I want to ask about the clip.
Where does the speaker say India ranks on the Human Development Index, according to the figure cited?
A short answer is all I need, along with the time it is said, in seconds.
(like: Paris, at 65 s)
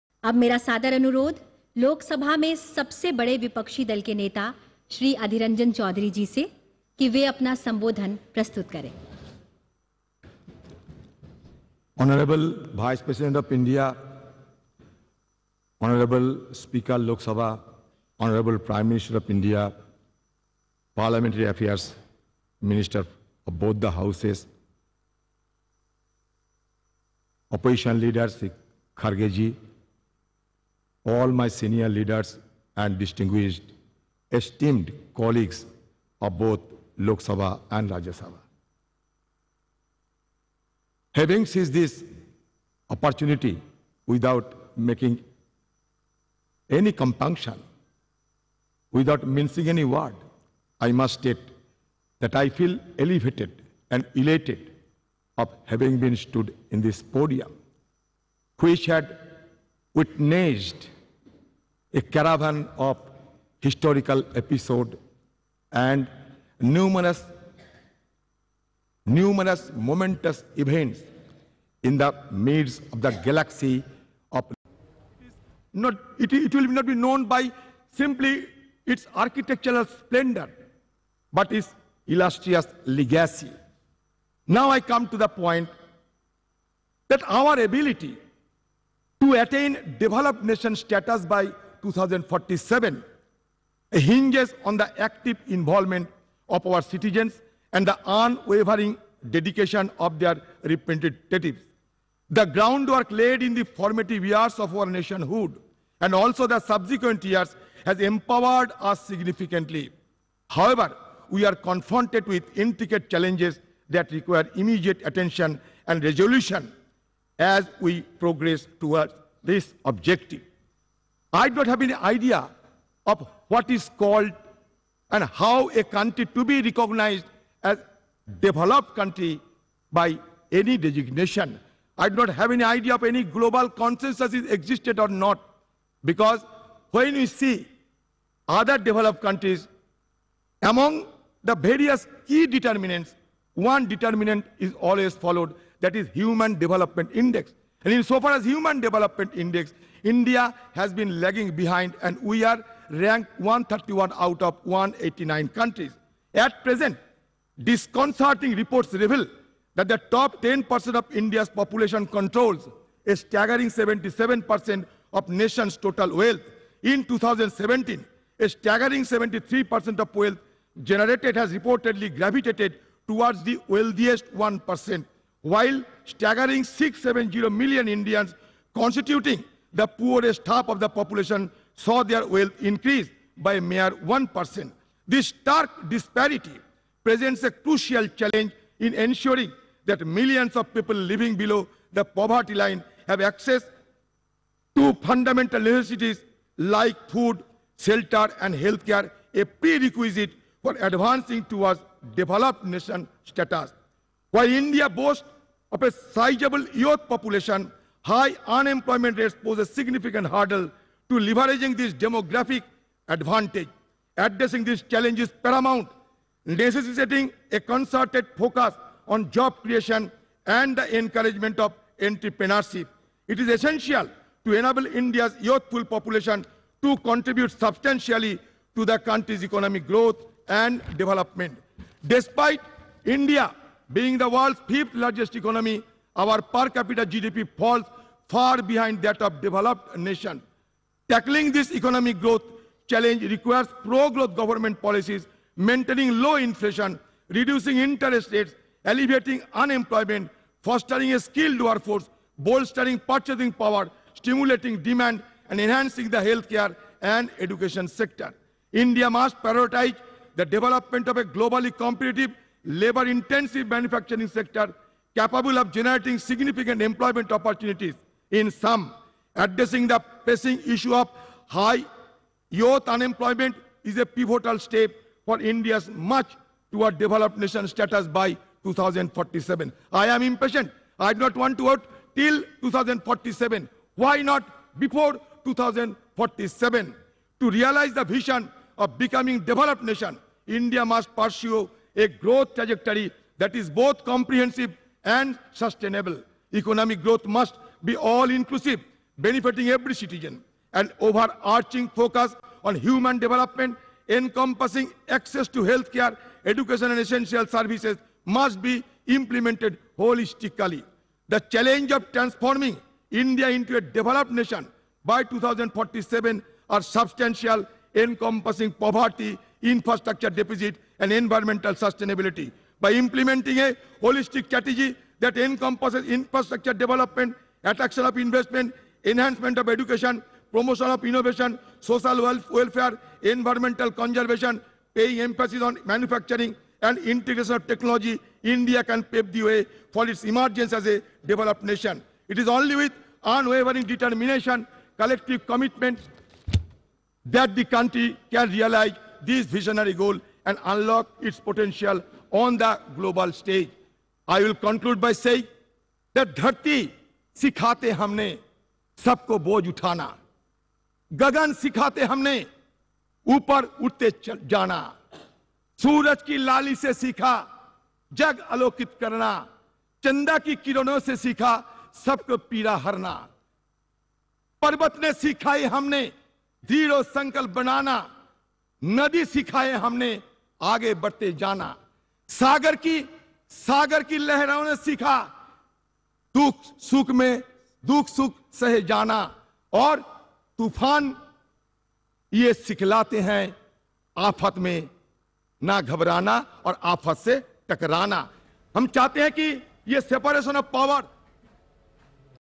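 131, at 153 s.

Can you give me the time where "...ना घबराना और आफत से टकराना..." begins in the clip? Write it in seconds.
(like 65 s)
395 s.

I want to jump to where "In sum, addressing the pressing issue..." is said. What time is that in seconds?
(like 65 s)
268 s.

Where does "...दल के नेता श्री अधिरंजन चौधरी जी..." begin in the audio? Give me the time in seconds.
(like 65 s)
3 s.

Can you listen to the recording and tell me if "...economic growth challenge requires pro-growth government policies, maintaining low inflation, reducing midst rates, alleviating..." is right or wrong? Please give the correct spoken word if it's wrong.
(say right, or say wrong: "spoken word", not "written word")
wrong: "interest", not "midst".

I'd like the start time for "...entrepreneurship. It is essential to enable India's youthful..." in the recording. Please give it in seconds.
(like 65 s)
221 s.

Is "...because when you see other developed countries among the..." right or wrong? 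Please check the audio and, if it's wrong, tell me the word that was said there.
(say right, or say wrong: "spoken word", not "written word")
right.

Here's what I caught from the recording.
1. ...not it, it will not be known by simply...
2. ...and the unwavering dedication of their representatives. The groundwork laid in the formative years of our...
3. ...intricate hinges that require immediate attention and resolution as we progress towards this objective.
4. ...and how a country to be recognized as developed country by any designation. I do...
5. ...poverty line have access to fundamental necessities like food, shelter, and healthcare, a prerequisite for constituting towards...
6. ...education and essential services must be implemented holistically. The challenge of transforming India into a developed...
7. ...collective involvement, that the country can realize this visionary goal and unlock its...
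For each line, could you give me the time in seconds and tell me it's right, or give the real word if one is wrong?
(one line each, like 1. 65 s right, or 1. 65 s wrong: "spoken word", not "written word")
1. 75 s right
2. 97 s right
3. 112 s wrong: "challenges", not "hinges"
4. 125 s right
5. 192 s wrong: "advancing", not "constituting"
6. 306 s right
7. 344 s wrong: "commitment", not "involvement".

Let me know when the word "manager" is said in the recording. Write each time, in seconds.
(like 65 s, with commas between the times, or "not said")
not said.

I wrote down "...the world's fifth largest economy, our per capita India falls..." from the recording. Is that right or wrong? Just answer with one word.
wrong.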